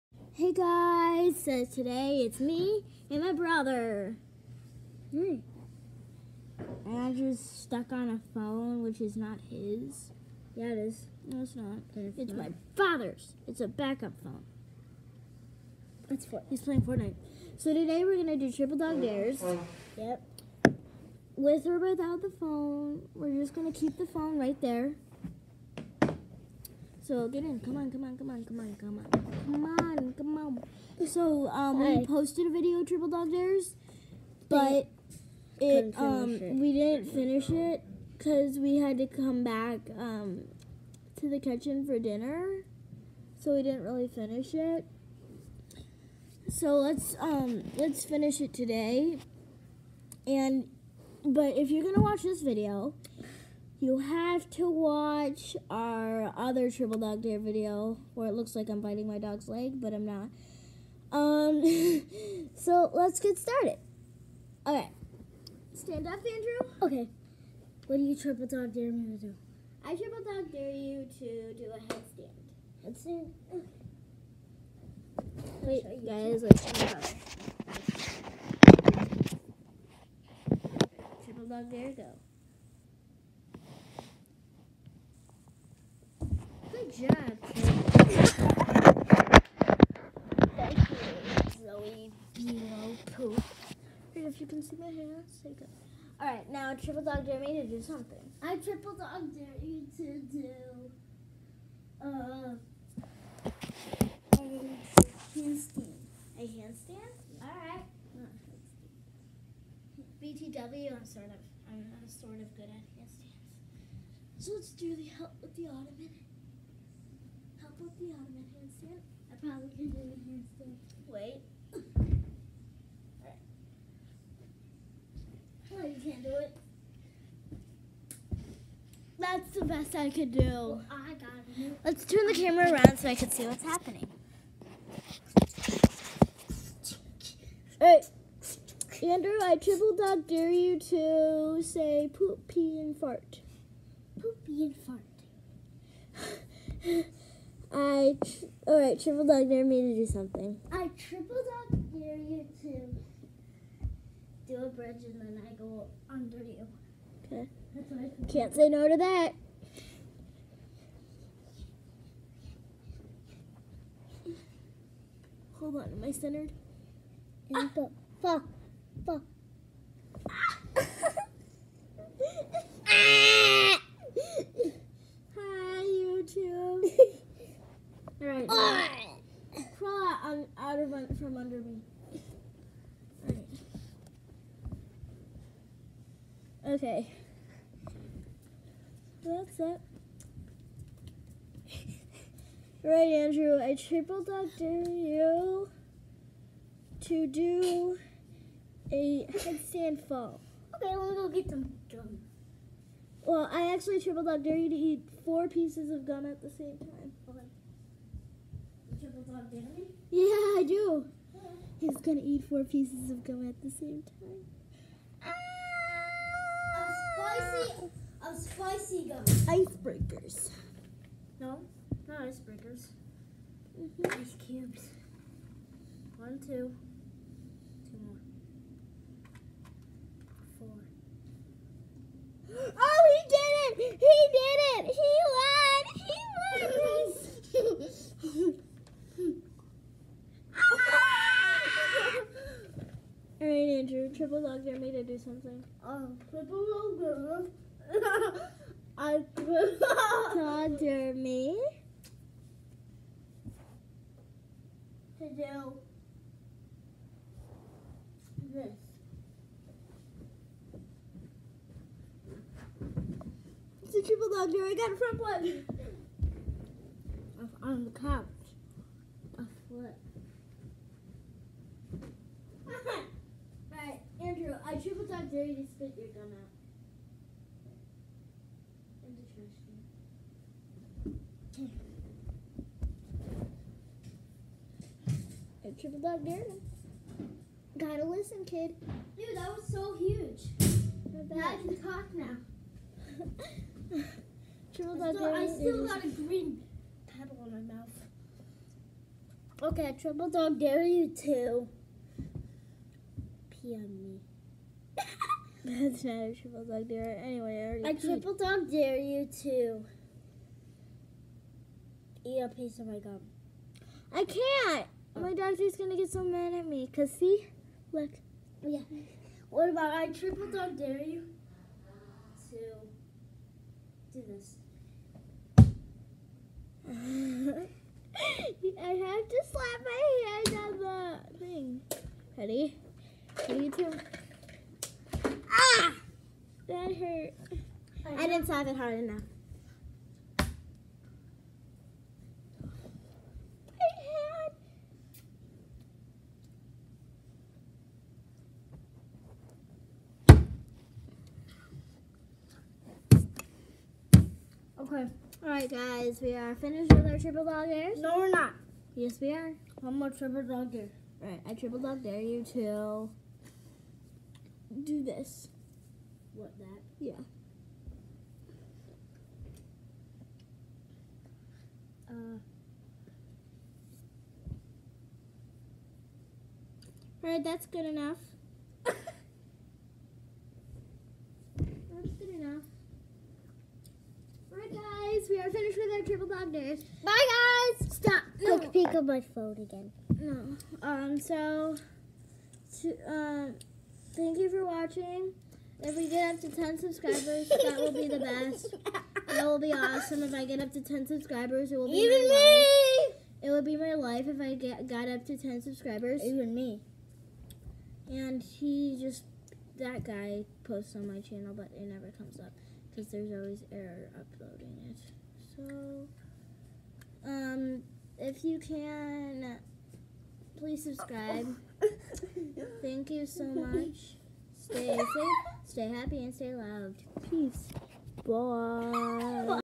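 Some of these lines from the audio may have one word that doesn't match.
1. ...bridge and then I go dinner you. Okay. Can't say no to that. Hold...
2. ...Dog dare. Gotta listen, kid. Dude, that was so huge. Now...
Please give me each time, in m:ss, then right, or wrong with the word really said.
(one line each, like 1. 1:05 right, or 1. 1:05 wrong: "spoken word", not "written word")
1. 2:34 wrong: "under", not "dinner"
2. 4:46 right.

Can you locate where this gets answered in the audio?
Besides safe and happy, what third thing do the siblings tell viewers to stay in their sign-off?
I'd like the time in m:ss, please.
7:06.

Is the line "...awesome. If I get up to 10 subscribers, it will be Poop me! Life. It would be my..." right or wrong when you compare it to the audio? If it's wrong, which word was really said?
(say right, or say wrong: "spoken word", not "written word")
wrong: "Even", not "Poop".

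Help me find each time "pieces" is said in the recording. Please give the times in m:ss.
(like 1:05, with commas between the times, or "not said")
3:25, 3:32, 5:12.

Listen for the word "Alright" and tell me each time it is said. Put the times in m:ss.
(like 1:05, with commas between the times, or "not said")
1:36, 1:47, 2:17, 3:03, 5:55, 6:01, 6:17.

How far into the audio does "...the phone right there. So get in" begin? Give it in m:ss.
0:23.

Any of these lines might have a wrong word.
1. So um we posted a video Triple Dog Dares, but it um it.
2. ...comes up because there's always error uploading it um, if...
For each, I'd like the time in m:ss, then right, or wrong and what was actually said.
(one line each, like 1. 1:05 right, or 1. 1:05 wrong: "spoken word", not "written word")
1. 0:31 right
2. 6:52 right.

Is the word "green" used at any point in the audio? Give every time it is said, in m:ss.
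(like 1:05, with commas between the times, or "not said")
4:56.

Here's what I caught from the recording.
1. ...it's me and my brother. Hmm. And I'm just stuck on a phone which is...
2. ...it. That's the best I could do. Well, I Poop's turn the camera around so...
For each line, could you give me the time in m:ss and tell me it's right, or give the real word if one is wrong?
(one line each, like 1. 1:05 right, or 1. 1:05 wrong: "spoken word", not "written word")
1. 0:02 right
2. 2:06 wrong: "Let", not "Poop".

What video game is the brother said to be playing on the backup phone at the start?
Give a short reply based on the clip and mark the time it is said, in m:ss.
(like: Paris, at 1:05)
Fortnite, at 0:16.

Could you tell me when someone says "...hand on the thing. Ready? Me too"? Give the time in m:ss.
5:30.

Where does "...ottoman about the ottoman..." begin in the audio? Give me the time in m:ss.
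1:55.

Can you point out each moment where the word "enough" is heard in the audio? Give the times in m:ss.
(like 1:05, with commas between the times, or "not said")
5:38, 6:17.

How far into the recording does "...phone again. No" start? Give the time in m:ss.
6:29.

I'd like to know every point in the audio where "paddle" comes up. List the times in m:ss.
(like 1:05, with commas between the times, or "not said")
4:57.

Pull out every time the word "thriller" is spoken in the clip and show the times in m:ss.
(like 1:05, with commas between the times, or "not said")
not said.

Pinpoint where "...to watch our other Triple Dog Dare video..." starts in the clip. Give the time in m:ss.
0:54.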